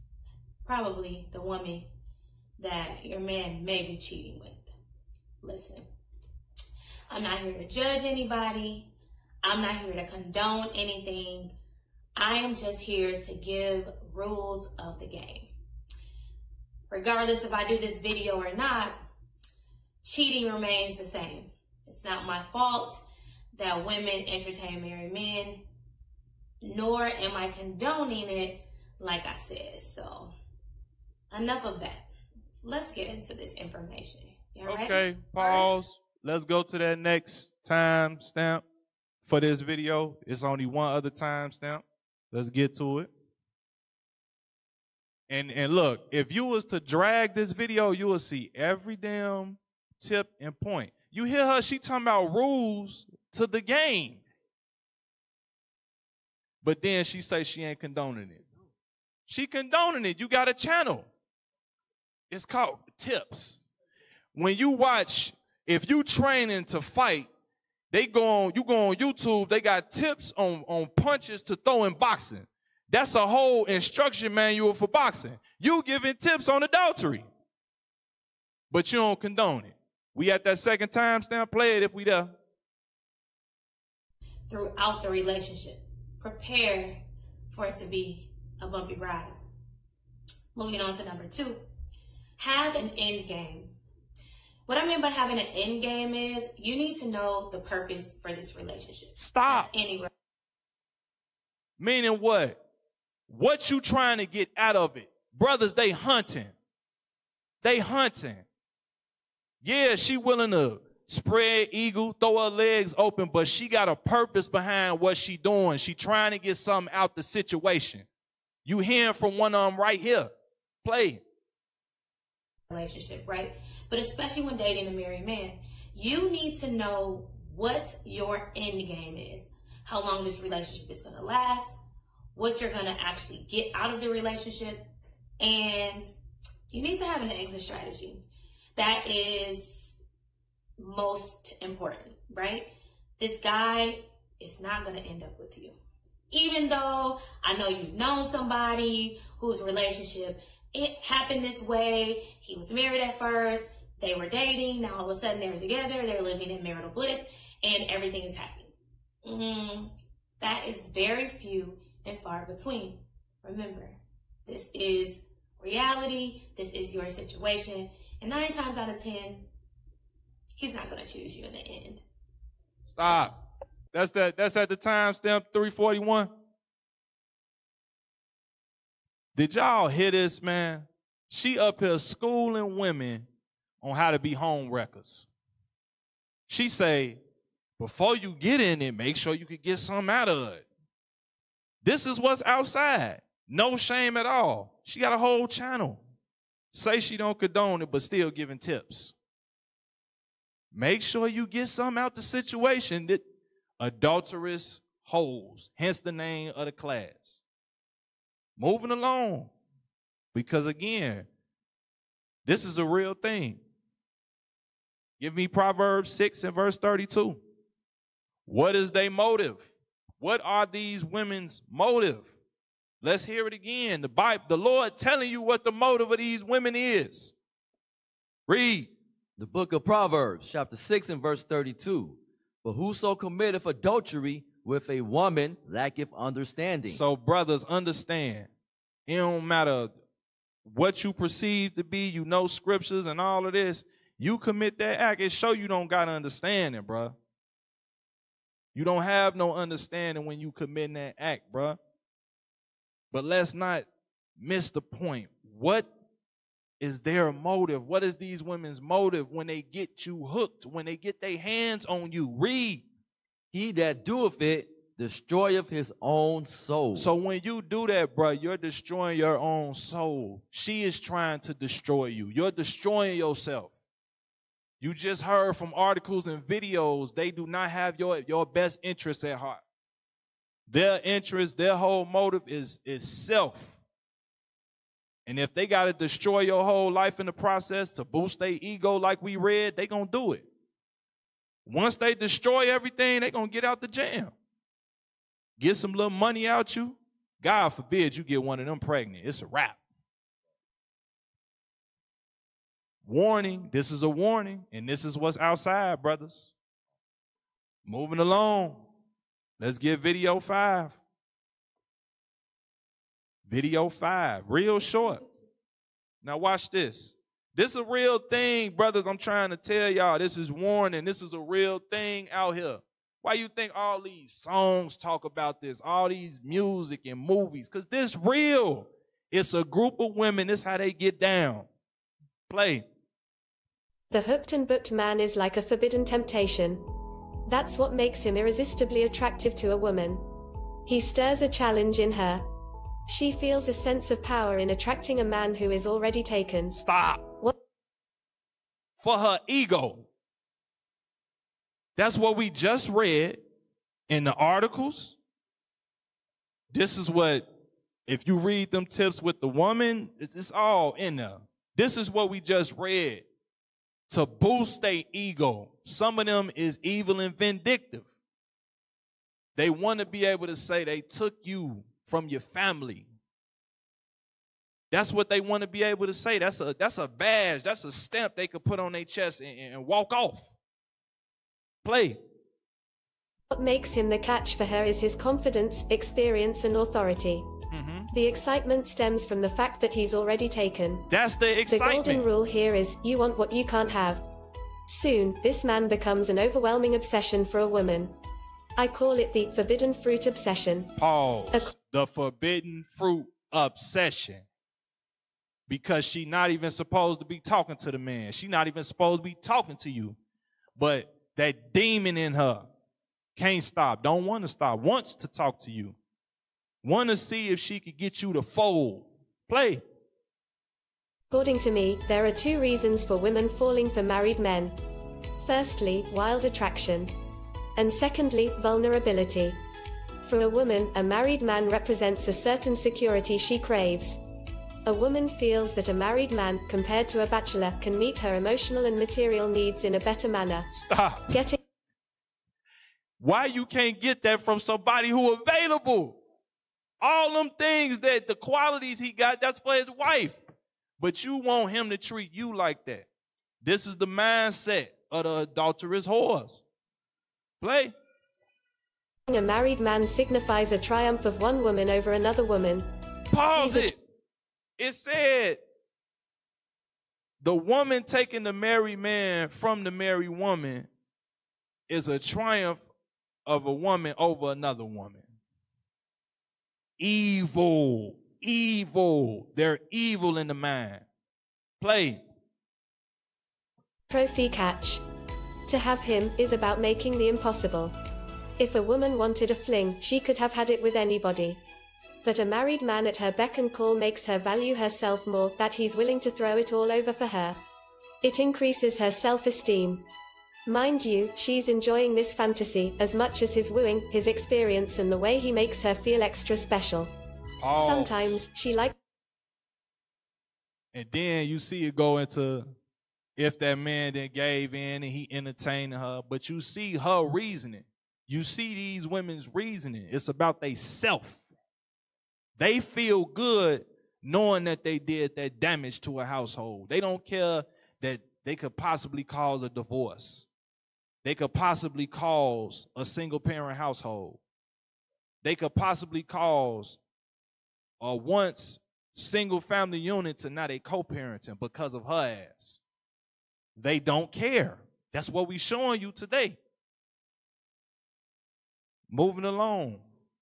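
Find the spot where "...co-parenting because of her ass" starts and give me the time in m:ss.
9:00.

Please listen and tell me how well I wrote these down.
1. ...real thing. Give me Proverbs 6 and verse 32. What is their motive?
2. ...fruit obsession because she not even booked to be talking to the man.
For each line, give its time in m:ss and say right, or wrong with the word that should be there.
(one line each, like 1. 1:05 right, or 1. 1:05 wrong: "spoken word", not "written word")
1. 3:32 right
2. 6:42 wrong: "supposed", not "booked".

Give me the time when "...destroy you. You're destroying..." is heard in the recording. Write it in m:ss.
4:31.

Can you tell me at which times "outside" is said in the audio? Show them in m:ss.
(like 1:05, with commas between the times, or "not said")
3:12, 5:05.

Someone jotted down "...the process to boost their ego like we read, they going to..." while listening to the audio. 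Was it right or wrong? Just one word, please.
right.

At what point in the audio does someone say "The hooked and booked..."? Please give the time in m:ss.
5:34.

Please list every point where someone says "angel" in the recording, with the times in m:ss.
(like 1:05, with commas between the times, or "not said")
not said.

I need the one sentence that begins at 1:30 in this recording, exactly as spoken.
Moving on to number two, have an end game.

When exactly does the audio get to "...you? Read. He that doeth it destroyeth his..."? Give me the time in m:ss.
4:22.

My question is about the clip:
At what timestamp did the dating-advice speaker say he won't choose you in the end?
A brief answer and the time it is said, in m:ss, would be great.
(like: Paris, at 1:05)
341, at 2:54.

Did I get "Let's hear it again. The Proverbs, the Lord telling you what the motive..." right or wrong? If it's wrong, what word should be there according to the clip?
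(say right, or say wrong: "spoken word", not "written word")
wrong: "Bible", not "Proverbs".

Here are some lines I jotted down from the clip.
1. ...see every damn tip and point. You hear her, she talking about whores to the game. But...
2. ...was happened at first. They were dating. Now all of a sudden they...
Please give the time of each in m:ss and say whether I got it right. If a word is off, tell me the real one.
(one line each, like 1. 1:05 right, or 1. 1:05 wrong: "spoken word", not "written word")
1. 0:48 wrong: "rules", not "whores"
2. 2:32 wrong: "married", not "happened".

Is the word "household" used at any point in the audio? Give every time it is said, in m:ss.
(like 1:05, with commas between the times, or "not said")
8:46, 8:53.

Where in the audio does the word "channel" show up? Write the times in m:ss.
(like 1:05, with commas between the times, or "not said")
1:00, 3:15.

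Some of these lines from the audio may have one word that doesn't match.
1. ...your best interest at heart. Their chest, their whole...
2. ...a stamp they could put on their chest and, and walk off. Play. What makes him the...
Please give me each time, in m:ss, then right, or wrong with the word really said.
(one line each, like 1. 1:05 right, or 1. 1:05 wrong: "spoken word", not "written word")
1. 4:38 wrong: "interest", not "chest"
2. 6:17 right.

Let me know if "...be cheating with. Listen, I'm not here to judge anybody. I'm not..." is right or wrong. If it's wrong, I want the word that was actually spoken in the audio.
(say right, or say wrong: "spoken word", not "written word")
right.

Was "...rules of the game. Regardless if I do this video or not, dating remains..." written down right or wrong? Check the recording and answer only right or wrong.
wrong.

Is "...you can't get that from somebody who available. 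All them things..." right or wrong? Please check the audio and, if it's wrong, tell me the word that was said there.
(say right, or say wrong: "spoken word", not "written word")
right.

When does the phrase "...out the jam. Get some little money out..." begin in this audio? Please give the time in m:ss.
4:53.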